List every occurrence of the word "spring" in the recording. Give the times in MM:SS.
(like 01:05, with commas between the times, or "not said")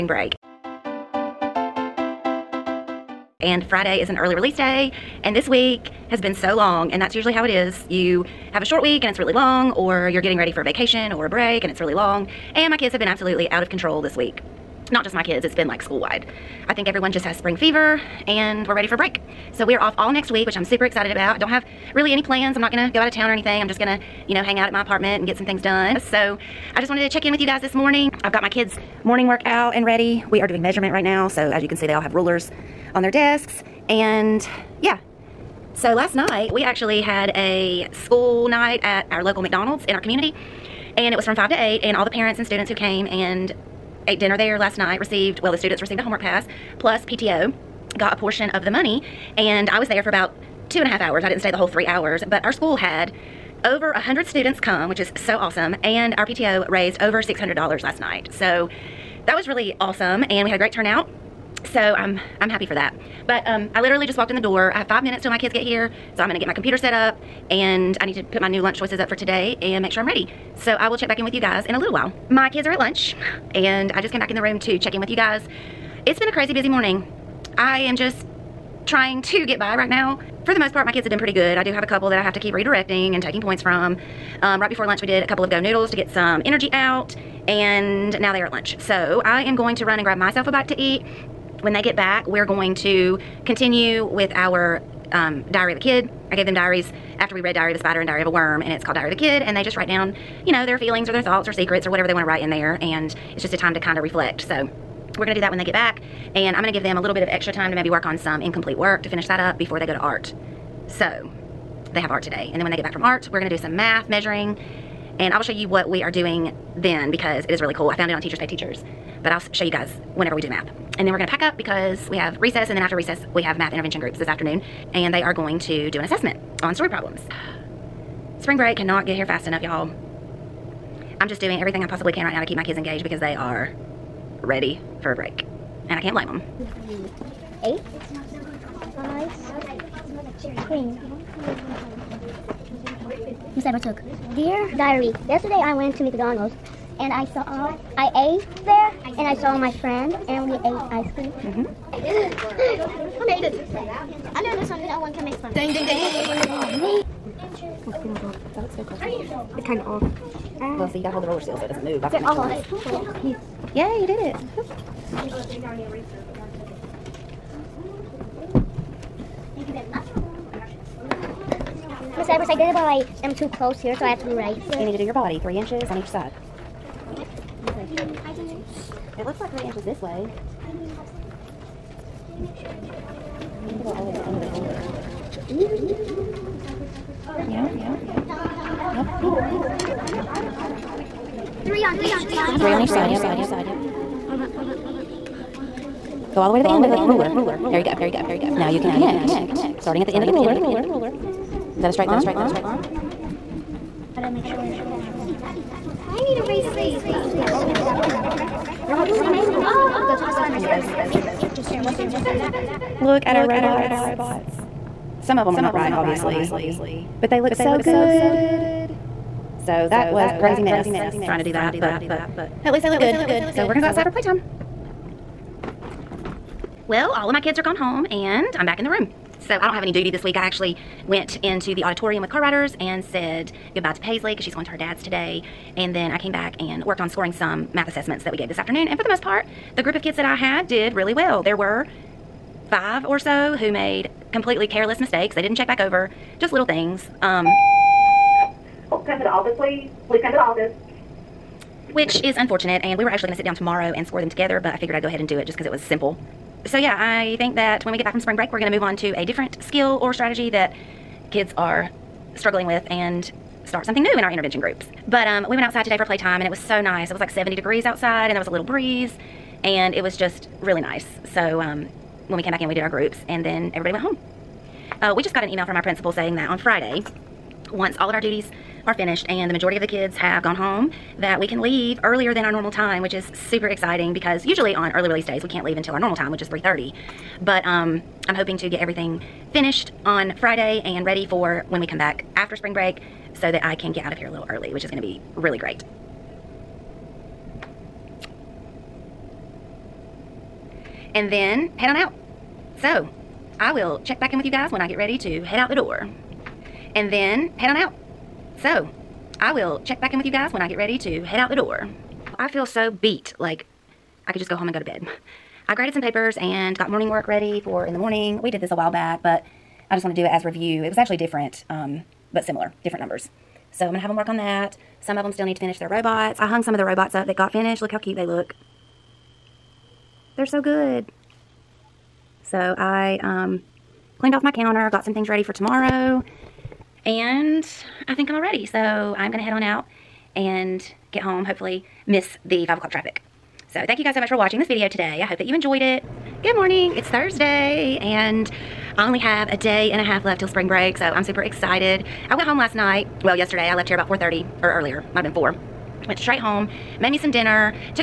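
00:17, 02:08, 04:18, 04:52, 05:50.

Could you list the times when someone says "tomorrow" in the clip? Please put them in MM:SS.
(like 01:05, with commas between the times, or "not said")
04:13, 05:35.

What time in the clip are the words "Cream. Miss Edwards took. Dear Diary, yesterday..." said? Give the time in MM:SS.
02:20.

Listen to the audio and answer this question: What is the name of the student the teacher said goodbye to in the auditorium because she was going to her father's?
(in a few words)
Paisley.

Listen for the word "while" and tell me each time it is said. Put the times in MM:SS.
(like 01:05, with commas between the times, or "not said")
01:11, 05:18.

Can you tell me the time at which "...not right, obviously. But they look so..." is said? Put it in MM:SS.
03:35.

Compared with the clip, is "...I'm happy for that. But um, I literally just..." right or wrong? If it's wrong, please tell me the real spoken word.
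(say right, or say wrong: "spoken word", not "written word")
right.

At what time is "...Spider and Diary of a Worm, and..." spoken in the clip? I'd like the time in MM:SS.
01:37.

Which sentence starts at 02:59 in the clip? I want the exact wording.
It looks like three inches this way.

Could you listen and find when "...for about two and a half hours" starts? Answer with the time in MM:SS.
00:50.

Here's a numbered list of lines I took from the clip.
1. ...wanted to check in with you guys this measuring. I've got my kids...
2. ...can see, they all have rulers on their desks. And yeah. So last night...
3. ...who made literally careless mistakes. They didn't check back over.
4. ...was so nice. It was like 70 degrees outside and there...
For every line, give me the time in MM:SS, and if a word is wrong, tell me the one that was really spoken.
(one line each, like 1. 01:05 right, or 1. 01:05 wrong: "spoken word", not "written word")
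1. 00:26 wrong: "morning", not "measuring"
2. 00:31 right
3. 04:03 wrong: "completely", not "literally"
4. 04:26 right.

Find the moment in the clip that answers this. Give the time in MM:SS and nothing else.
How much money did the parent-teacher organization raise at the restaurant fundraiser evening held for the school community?
00:57.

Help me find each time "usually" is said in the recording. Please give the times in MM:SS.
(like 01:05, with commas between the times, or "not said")
00:07, 04:44.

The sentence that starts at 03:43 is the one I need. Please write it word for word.
So we're gonna go outside for playtime.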